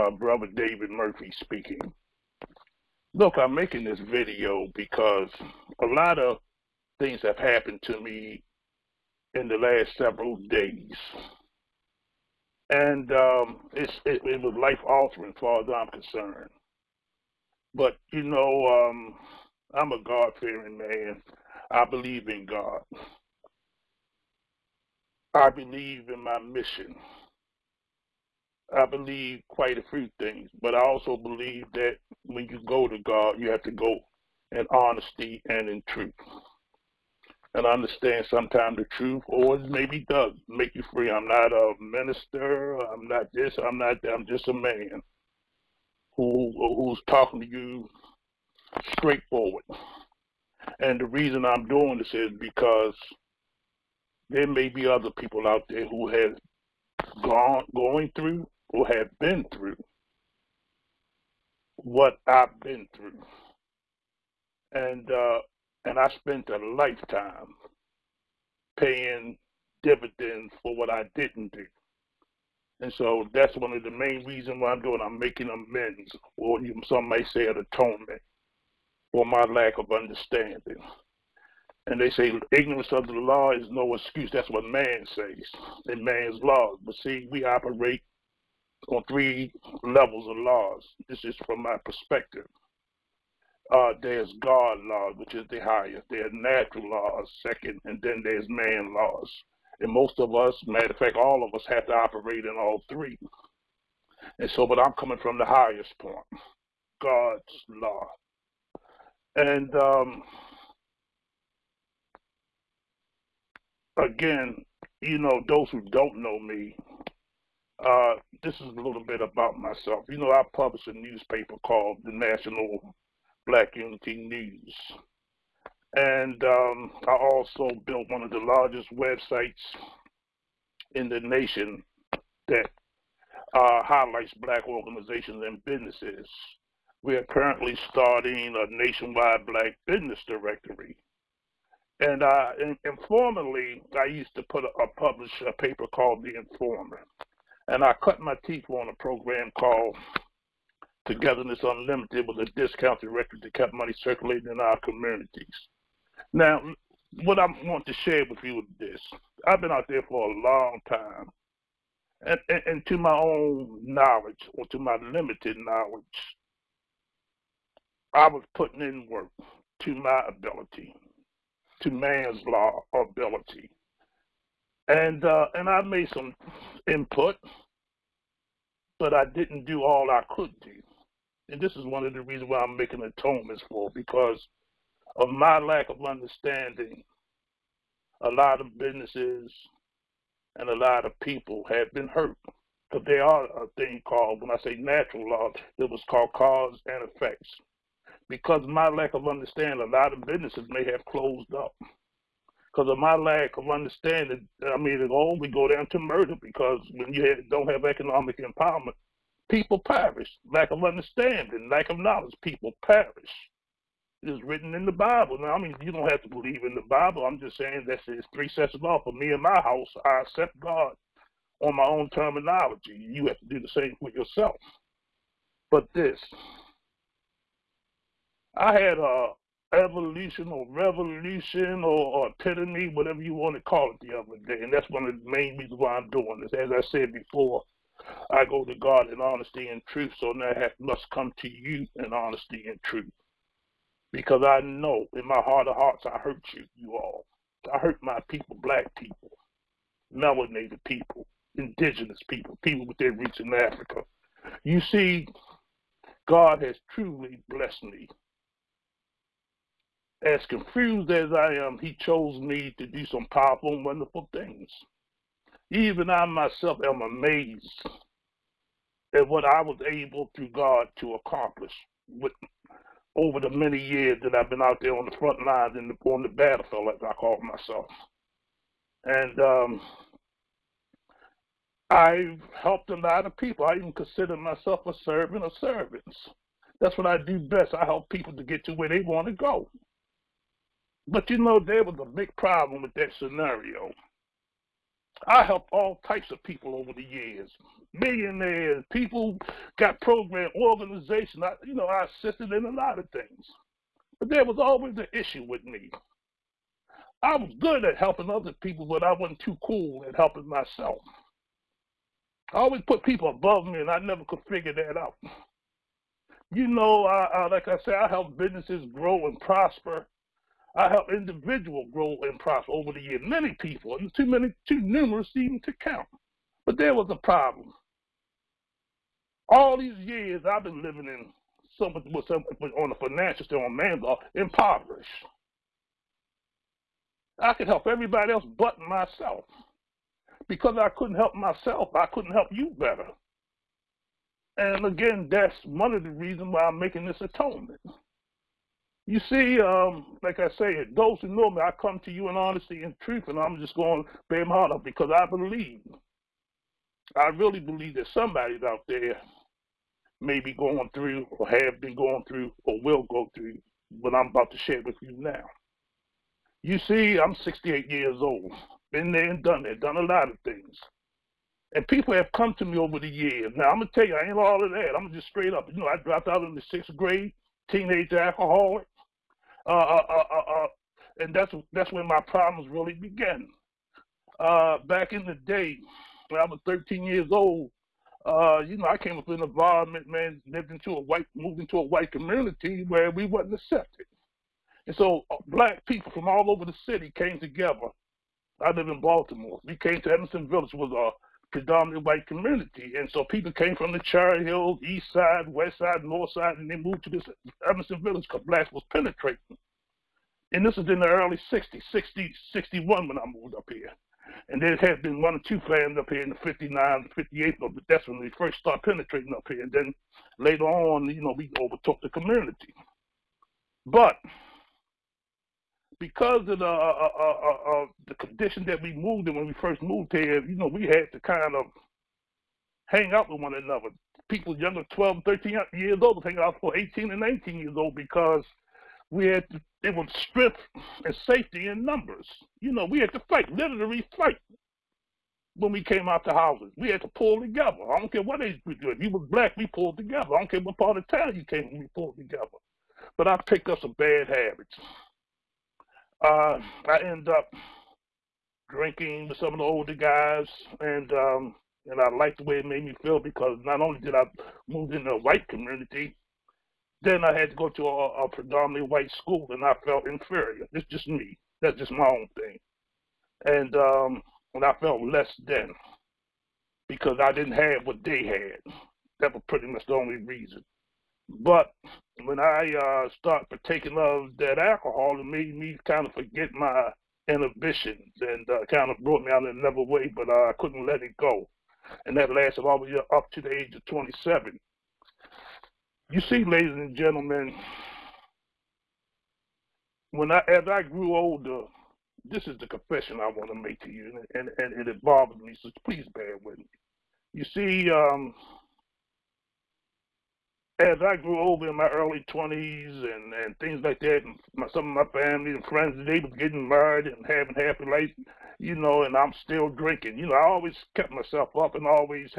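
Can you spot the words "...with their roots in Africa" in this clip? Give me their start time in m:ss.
4:12.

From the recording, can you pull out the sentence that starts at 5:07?
I was good at helping other people, but I wasn't too cool at helping myself.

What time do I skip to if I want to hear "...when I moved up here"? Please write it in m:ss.
6:53.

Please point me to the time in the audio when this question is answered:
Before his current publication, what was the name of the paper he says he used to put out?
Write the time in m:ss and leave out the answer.
2:26.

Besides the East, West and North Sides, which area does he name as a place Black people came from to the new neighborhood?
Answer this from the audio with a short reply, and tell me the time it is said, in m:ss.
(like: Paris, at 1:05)
Cherry Hills, at 6:43.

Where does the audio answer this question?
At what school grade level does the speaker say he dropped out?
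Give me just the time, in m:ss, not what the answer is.
6:16.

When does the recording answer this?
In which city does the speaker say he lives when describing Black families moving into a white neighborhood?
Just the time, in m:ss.
6:39.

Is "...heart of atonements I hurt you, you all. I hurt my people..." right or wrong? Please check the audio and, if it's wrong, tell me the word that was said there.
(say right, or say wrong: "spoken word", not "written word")
wrong: "hearts", not "atonements".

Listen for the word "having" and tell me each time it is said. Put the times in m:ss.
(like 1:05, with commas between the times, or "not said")
8:37.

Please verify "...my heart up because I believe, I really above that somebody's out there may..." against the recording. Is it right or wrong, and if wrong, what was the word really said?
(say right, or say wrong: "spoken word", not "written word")
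wrong: "believe", not "above".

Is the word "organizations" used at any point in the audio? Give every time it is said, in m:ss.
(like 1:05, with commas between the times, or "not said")
2:14, 5:00.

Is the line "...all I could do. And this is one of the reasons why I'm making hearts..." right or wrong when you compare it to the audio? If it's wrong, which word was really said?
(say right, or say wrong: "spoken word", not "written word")
wrong: "atonements", not "hearts".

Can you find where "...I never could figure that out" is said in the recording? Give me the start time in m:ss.
5:13.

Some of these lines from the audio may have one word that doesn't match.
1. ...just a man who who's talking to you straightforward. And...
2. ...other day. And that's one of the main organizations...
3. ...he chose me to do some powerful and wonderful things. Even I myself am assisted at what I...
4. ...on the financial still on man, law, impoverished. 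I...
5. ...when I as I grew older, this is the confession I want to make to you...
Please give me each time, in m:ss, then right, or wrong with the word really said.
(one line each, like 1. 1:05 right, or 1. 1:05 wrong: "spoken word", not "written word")
1. 0:44 right
2. 3:54 wrong: "reasons", not "organizations"
3. 4:21 wrong: "amazed", not "assisted"
4. 5:32 right
5. 8:20 right.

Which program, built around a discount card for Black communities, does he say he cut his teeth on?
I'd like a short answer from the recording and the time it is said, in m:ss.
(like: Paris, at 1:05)
Togetherness Unlimited, at 2:31.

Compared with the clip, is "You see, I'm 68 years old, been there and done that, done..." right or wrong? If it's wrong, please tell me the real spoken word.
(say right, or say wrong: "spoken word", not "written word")
right.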